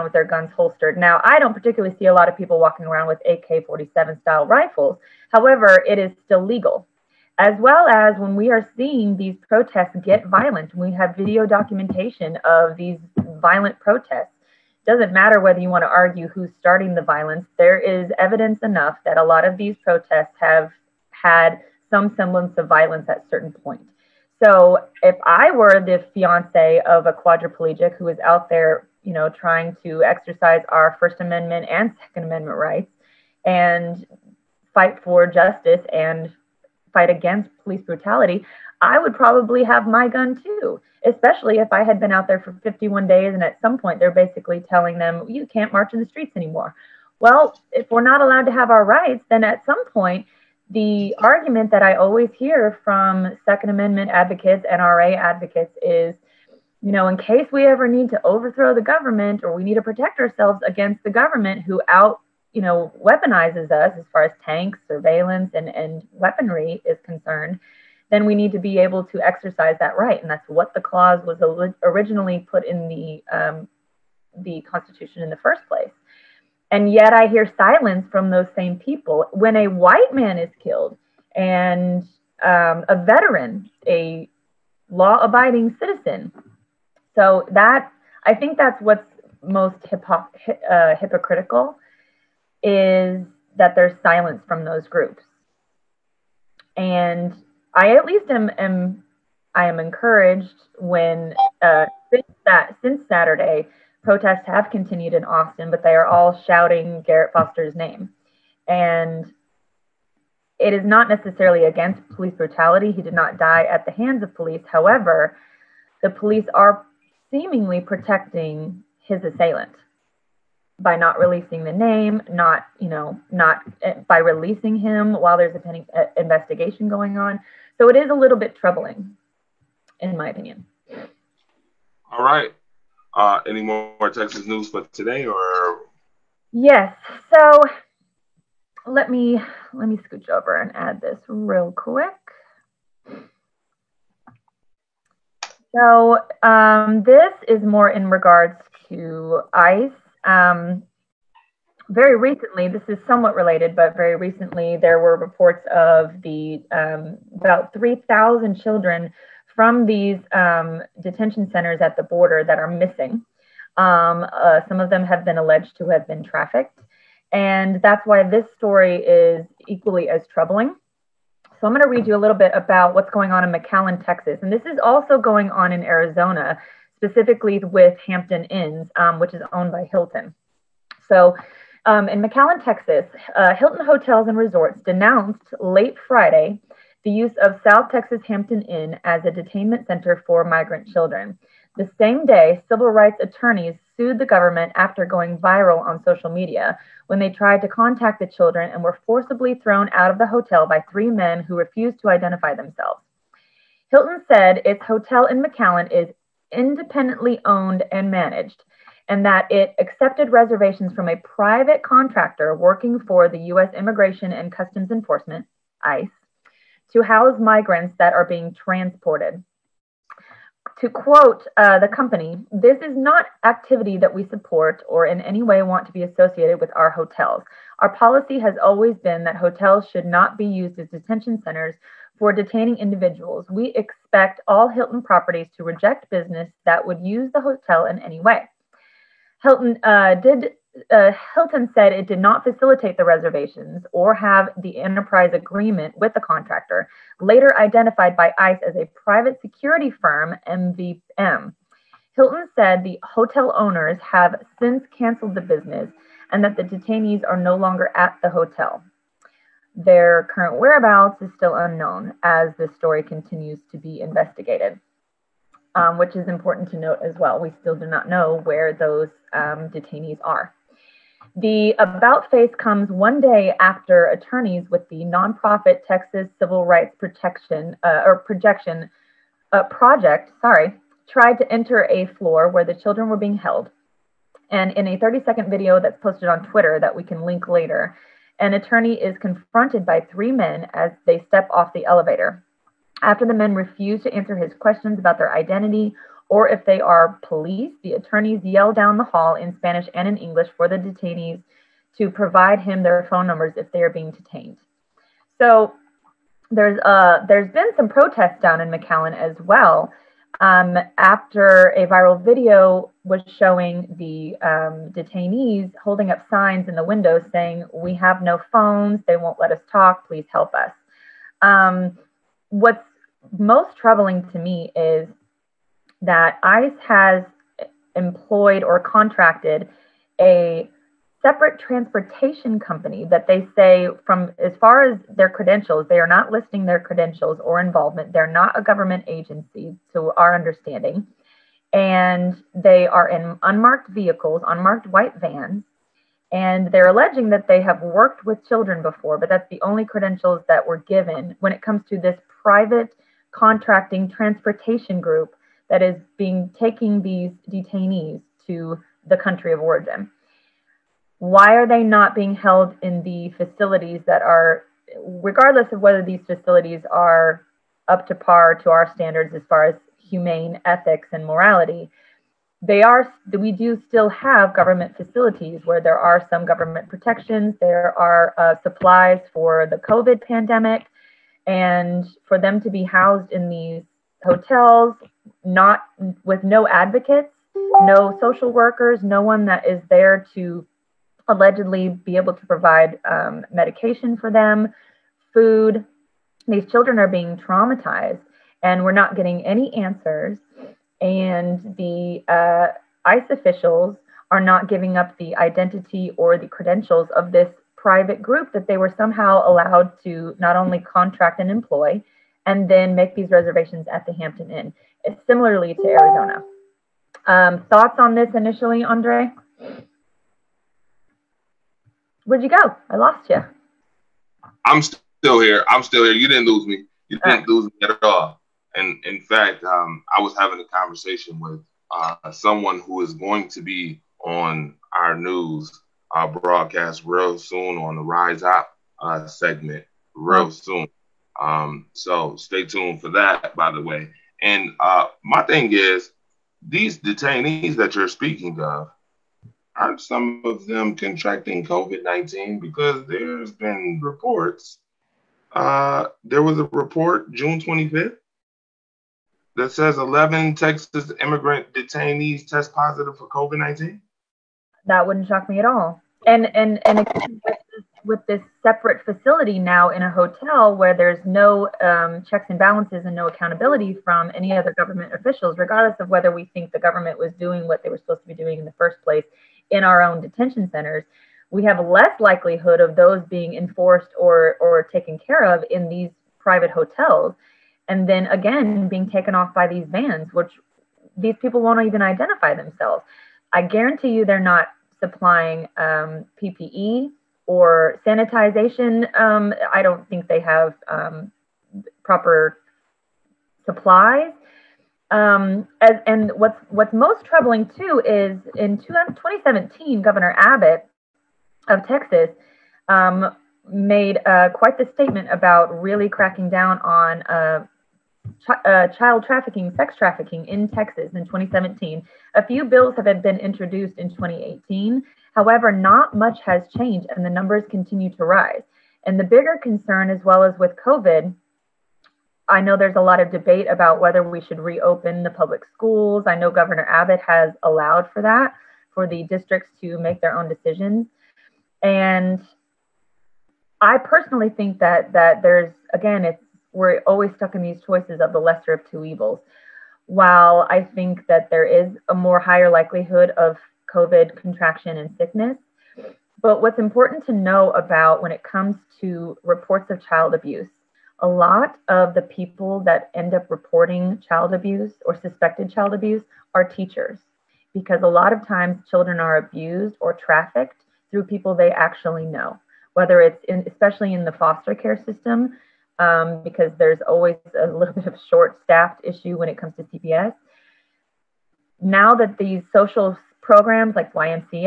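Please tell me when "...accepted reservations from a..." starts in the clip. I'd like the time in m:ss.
3:29.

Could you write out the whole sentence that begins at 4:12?
Hilton said the hotel owners have since canceled the business and that the detainees are no longer at the hotel.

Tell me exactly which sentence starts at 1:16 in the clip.
And yet I hear silence from those same people.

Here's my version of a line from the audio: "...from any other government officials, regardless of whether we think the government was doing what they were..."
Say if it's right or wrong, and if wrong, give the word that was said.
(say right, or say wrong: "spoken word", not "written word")
right.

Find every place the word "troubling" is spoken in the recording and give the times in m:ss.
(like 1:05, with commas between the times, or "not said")
2:08, 2:50, 5:23, 8:27.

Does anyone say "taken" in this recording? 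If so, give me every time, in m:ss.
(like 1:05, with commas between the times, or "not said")
8:04, 8:09.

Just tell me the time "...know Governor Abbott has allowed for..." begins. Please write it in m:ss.
8:56.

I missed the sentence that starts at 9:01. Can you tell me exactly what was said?
And I personally think that that there's again, it's we're always stuck in these choices of the lesser of two evils.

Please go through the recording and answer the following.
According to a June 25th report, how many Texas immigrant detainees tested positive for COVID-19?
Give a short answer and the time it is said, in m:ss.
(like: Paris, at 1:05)
11, at 7:39.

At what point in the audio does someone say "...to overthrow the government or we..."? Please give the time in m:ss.
0:58.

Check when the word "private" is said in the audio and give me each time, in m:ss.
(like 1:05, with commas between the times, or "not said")
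3:31, 4:09, 5:52, 6:47, 8:06.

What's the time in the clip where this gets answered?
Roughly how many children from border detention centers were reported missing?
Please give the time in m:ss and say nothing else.
2:37.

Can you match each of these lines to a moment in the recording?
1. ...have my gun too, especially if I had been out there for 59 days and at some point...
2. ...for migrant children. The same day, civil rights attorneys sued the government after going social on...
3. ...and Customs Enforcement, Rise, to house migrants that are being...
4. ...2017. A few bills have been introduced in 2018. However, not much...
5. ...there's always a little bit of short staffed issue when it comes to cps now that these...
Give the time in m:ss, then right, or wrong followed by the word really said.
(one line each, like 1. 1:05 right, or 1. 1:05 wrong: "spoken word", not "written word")
1. 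0:39 wrong: "51", not "59"
2. 3:10 wrong: "viral", not "social"
3. 3:34 wrong: "ICE", not "Rise"
4. 8:41 right
5. 9:36 right.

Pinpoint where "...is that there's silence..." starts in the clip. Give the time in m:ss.
1:32.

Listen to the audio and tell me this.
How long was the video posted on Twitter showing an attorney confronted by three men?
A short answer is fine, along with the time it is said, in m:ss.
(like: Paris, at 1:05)
30 seconds, at 4:44.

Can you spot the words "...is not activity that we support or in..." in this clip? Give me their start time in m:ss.
3:42.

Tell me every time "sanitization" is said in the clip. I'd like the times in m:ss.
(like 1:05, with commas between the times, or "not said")
8:18.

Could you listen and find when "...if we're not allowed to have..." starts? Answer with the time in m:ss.
0:47.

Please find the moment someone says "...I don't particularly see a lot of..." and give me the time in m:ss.
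0:01.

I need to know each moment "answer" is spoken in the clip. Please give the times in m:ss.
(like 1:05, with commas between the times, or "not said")
4:54, 6:39.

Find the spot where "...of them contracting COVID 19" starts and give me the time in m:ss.
7:30.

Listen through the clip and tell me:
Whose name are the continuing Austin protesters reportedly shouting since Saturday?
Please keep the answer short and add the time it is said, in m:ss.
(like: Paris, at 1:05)
Garrett Foster, at 1:47.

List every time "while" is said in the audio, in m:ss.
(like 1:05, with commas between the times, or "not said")
2:05, 9:10.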